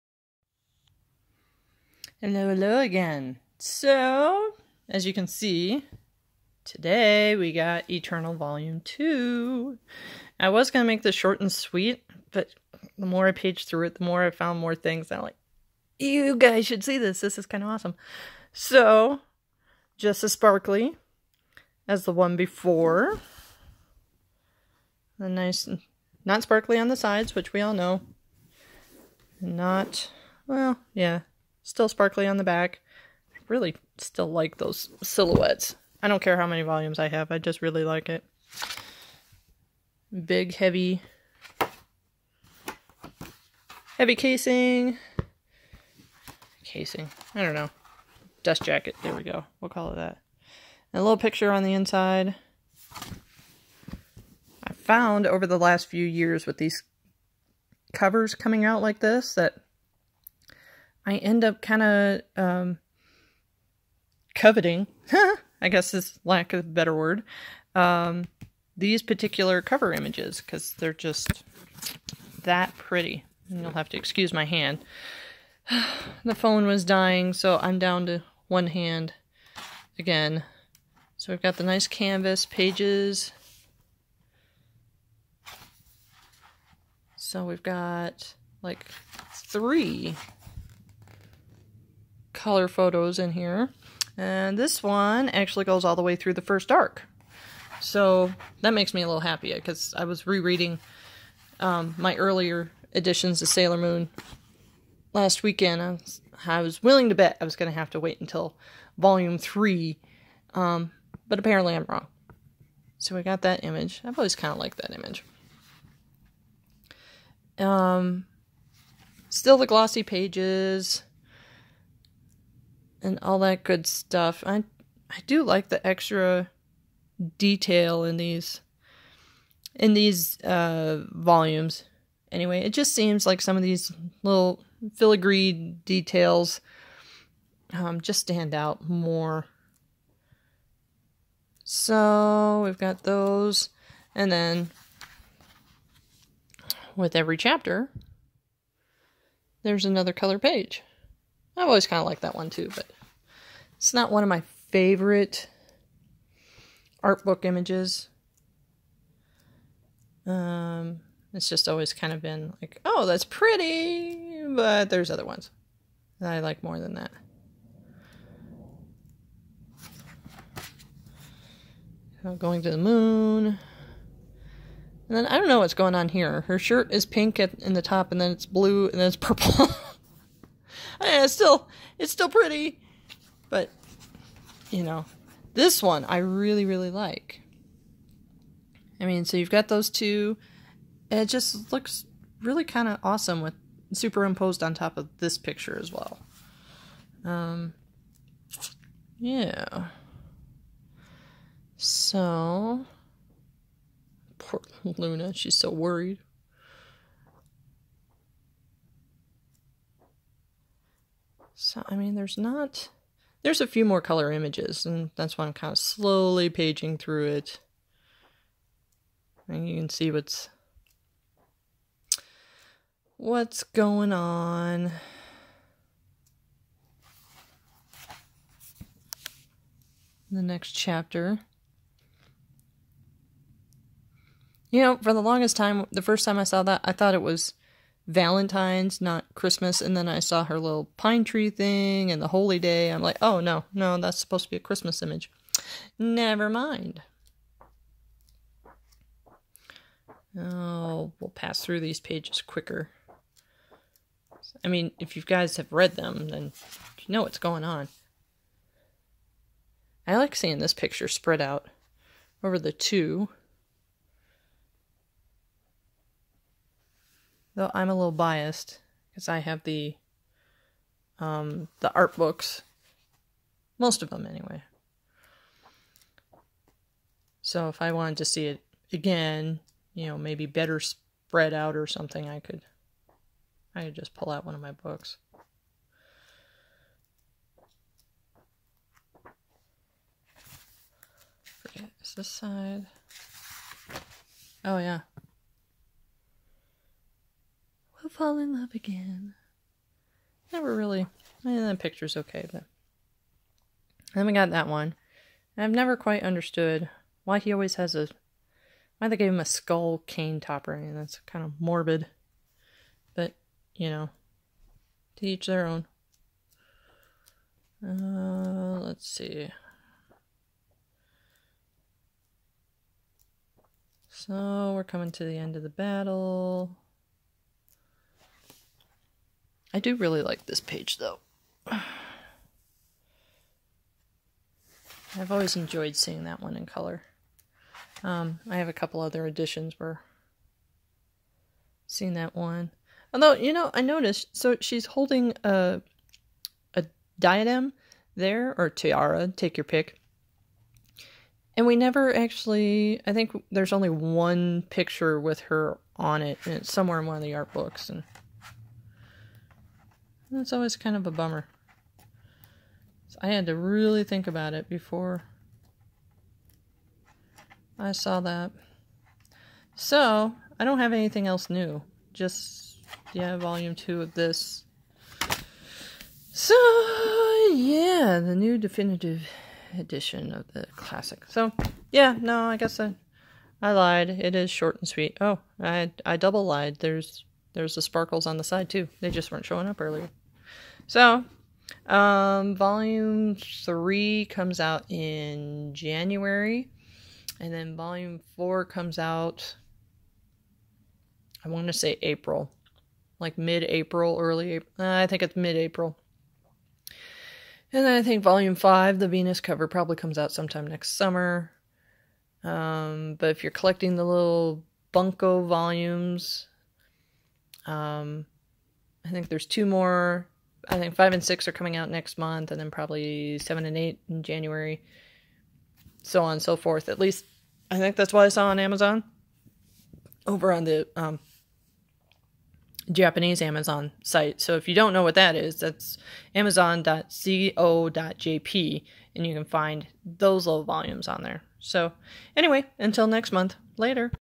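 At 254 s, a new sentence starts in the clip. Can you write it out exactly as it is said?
I mean, if you guys have read them, then you know what's going on.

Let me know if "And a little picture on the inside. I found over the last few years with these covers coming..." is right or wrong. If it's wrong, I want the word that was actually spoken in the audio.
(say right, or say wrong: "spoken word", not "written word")
right.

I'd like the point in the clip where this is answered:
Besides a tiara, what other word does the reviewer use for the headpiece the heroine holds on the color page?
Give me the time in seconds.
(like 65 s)
347 s.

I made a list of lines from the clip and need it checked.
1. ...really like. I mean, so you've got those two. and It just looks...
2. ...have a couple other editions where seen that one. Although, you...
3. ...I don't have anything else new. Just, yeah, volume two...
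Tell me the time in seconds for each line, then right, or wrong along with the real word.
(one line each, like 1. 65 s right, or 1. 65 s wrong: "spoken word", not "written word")
1. 186 s right
2. 338 s right
3. 370 s right.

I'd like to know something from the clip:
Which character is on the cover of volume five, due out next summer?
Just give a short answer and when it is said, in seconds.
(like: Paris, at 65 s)
Venus, at 409 s.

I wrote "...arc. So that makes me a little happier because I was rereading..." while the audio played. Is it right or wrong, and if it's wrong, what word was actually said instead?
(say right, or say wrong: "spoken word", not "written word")
right.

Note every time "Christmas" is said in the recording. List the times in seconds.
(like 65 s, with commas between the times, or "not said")
239 s, 244 s.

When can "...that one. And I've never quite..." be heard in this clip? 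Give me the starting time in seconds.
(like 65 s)
304 s.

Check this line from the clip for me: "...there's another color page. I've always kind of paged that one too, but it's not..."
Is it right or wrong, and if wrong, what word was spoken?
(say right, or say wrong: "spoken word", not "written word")
wrong: "liked", not "paged".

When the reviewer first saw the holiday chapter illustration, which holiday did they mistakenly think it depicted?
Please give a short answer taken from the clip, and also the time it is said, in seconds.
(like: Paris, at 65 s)
Valentine's, at 238 s.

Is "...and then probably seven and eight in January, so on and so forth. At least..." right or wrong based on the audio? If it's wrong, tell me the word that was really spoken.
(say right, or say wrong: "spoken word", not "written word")
right.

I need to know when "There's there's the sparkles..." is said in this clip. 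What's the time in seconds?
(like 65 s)
386 s.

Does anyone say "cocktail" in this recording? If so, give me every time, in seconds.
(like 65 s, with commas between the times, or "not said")
not said.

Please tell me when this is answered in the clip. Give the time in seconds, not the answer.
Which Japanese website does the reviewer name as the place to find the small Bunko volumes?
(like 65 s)
436 s.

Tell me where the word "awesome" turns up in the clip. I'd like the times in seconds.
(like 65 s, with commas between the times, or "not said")
17 s, 193 s.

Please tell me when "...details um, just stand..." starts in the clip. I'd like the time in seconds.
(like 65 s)
135 s.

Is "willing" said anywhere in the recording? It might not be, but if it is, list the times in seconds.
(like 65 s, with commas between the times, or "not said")
106 s.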